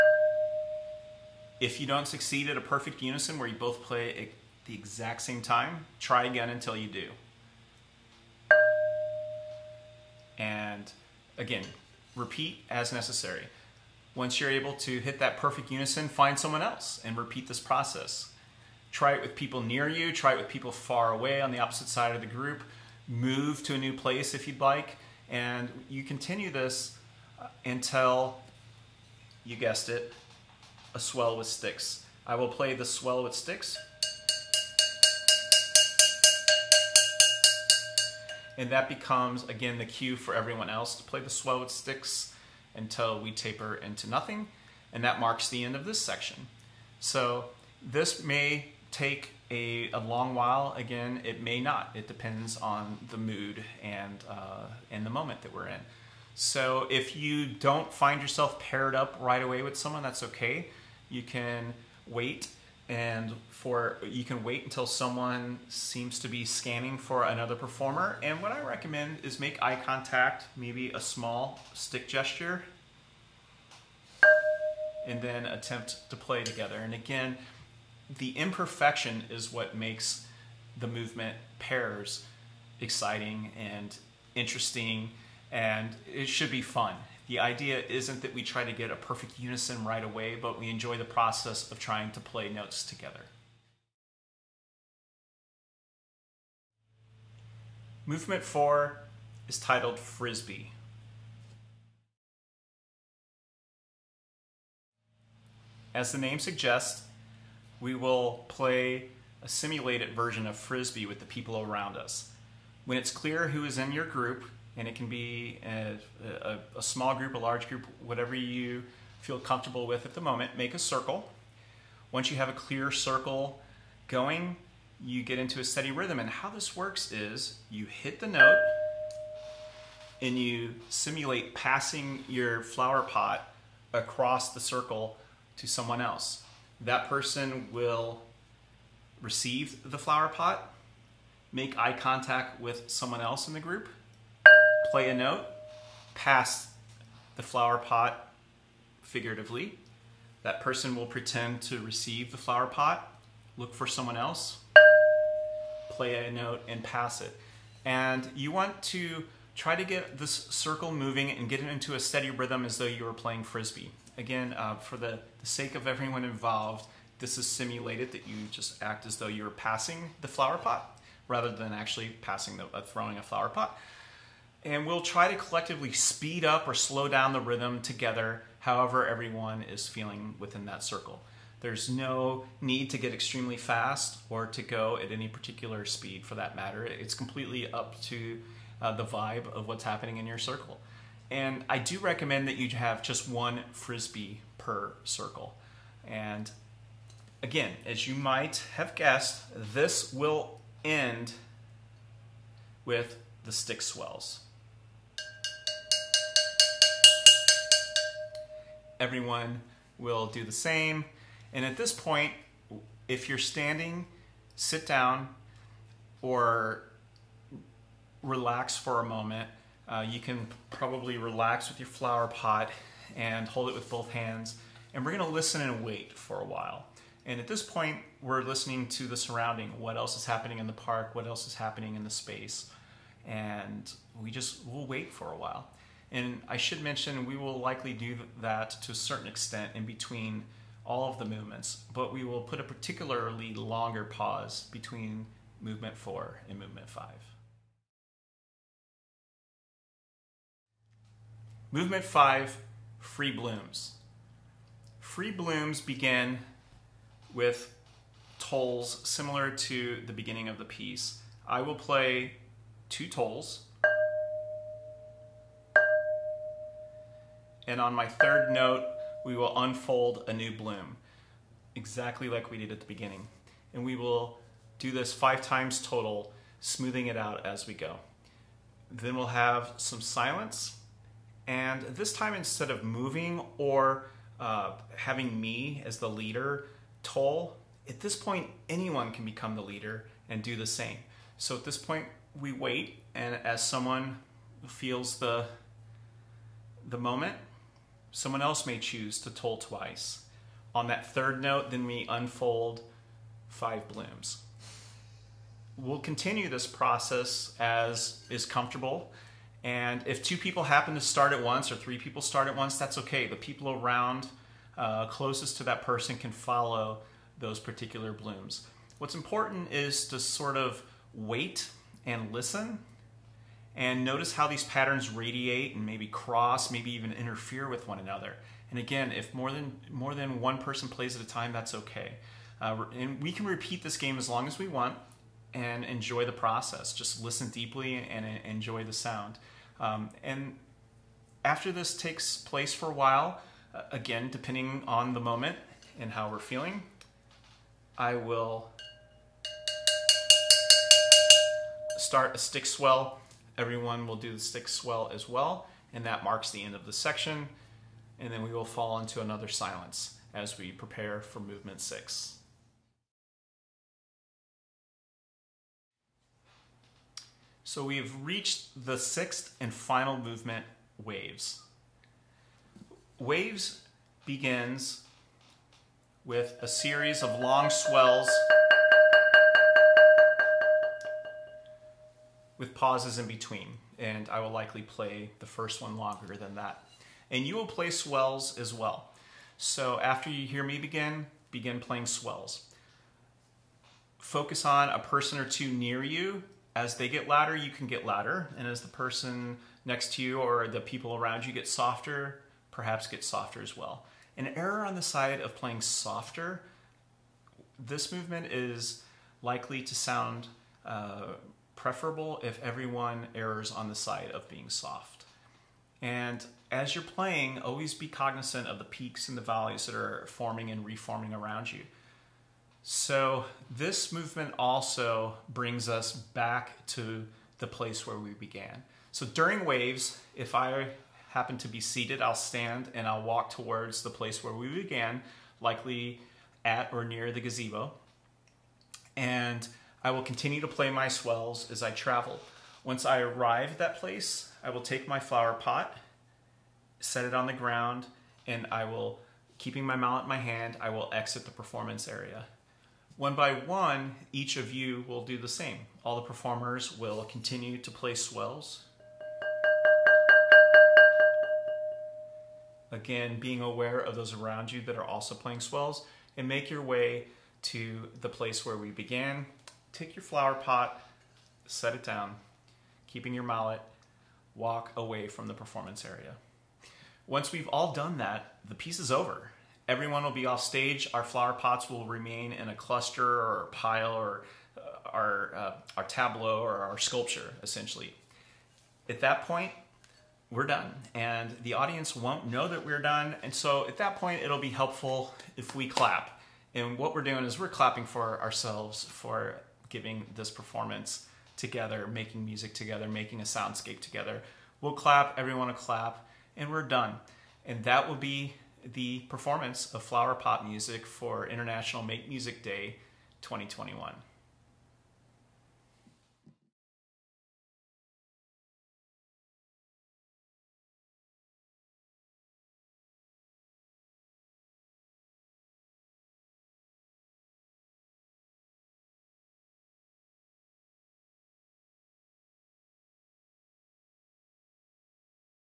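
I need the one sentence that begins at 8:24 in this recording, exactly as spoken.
We'll clap, everyone will clap, and we're done.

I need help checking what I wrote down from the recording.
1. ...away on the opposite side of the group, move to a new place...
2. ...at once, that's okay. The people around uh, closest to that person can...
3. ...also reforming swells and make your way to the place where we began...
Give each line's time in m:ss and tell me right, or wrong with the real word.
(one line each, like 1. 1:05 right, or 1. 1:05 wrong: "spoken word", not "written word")
1. 0:21 right
2. 5:12 right
3. 7:45 wrong: "playing", not "reforming".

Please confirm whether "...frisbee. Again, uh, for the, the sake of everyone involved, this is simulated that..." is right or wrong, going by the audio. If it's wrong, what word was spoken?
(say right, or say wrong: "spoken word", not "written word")
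right.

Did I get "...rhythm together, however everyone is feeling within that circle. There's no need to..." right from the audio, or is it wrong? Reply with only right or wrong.
right.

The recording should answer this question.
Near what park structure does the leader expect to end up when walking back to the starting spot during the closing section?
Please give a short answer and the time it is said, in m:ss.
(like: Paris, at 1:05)
gazebo, at 7:17.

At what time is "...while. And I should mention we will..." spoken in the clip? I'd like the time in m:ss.
3:55.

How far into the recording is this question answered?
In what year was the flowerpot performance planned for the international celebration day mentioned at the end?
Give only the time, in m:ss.
8:33.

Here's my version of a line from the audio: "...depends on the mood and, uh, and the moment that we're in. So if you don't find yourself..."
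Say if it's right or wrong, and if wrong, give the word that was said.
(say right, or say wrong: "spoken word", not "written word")
right.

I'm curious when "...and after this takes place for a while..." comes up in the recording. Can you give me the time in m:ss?
5:40.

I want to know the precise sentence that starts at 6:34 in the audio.
Focus on a person or two near you.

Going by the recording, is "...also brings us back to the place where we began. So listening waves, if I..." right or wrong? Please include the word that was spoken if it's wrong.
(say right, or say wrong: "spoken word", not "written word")
wrong: "during", not "listening".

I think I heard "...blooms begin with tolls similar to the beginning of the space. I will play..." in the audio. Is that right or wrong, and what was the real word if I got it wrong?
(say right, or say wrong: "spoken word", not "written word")
wrong: "piece", not "space".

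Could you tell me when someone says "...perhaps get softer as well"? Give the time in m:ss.
6:42.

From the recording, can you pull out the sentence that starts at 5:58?
And then we will fall into another silence as we prepare for movement six.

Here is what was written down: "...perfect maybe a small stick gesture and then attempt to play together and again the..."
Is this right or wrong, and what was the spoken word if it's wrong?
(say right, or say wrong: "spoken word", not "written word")
wrong: "contact", not "perfect".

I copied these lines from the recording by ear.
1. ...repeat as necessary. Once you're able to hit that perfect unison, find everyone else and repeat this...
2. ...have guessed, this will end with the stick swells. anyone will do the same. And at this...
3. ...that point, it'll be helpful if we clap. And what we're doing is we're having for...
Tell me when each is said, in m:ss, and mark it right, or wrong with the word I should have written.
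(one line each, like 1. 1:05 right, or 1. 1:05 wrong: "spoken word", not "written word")
1. 0:12 wrong: "someone", not "everyone"
2. 3:18 wrong: "everyone", not "anyone"
3. 8:13 wrong: "clapping", not "having".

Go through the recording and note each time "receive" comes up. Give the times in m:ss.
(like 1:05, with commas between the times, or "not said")
2:19, 2:31.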